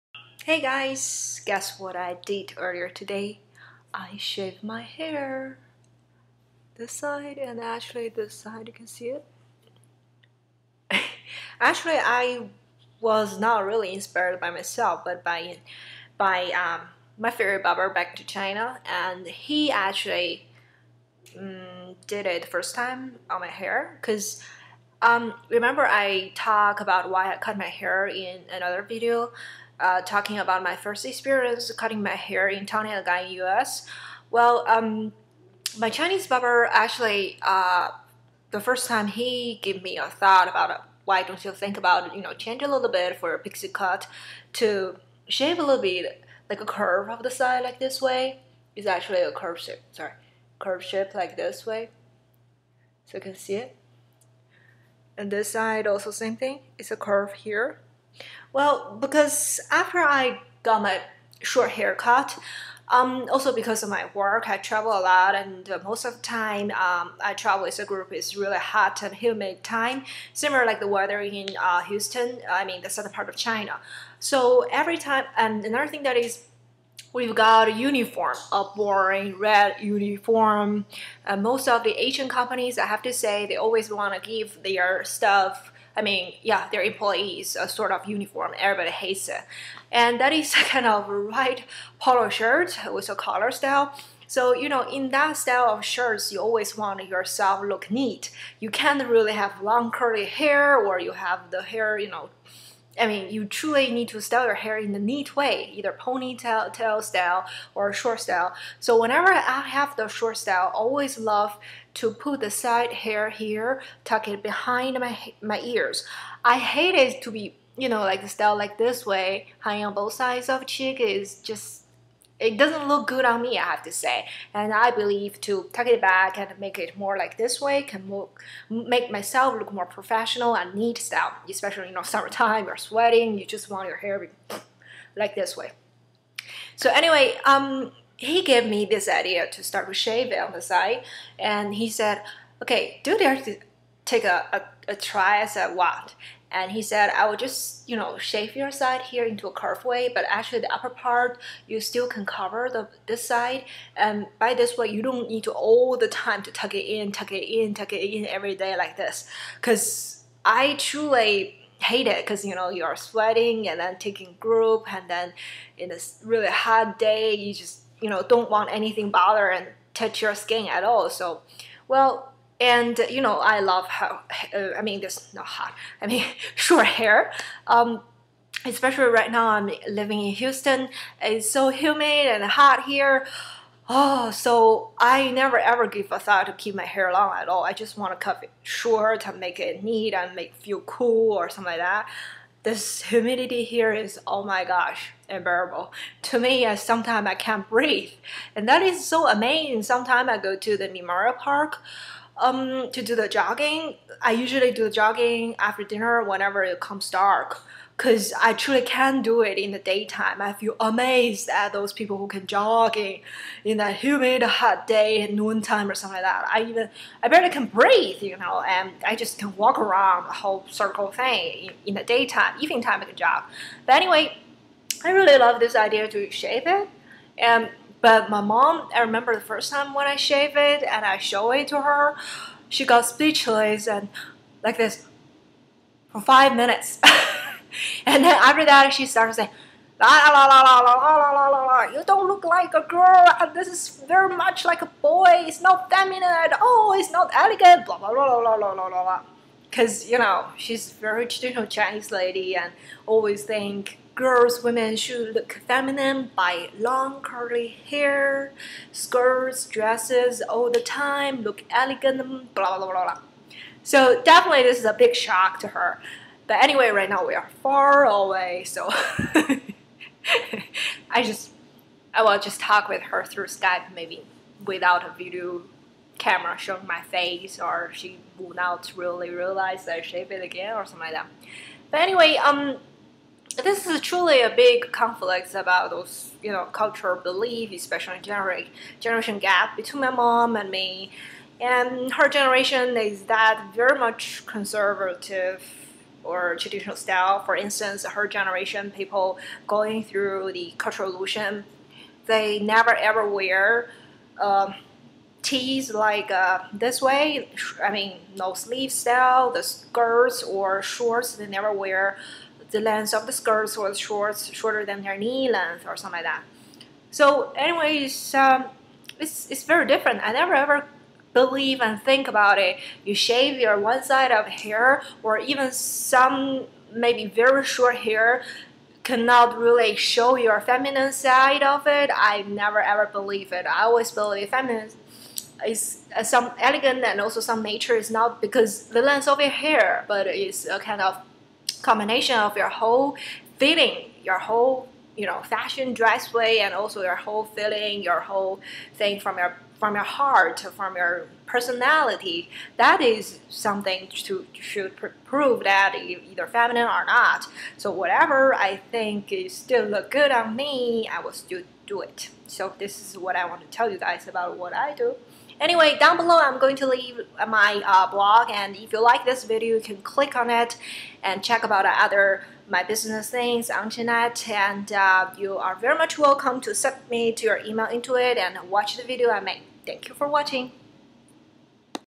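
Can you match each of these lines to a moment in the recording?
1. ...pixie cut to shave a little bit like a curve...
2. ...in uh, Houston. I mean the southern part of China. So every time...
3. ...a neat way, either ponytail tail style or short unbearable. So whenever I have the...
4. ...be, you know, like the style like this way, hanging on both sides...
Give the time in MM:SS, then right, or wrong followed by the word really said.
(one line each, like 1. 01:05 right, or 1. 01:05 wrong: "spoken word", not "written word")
1. 00:43 right
2. 01:11 right
3. 01:44 wrong: "style", not "unbearable"
4. 01:57 right.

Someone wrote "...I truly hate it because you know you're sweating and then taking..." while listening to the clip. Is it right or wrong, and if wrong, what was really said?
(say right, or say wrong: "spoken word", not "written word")
right.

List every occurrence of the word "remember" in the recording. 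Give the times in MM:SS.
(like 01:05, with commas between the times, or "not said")
00:25, 03:49.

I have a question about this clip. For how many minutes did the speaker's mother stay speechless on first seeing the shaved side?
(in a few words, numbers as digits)
5.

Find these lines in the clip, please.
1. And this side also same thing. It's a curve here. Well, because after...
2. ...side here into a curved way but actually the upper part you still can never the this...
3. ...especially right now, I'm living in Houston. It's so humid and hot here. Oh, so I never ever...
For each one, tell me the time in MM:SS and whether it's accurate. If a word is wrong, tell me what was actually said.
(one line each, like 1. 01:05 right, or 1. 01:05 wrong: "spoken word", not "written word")
1. 00:55 right
2. 02:28 wrong: "cover", not "never"
3. 02:58 right.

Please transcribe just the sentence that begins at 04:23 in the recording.
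So definitely this is a big shock to her.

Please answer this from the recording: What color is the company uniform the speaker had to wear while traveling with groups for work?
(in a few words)
Red.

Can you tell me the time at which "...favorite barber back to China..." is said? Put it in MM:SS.
00:17.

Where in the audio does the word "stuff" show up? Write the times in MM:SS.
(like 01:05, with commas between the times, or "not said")
01:25.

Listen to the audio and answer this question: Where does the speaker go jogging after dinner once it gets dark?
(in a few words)
Memorial Park.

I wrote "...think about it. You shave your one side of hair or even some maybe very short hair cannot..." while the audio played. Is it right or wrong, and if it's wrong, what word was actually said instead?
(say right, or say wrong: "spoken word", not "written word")
right.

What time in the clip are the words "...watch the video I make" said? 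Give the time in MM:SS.
06:18.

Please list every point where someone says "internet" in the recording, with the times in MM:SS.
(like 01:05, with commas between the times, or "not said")
06:13.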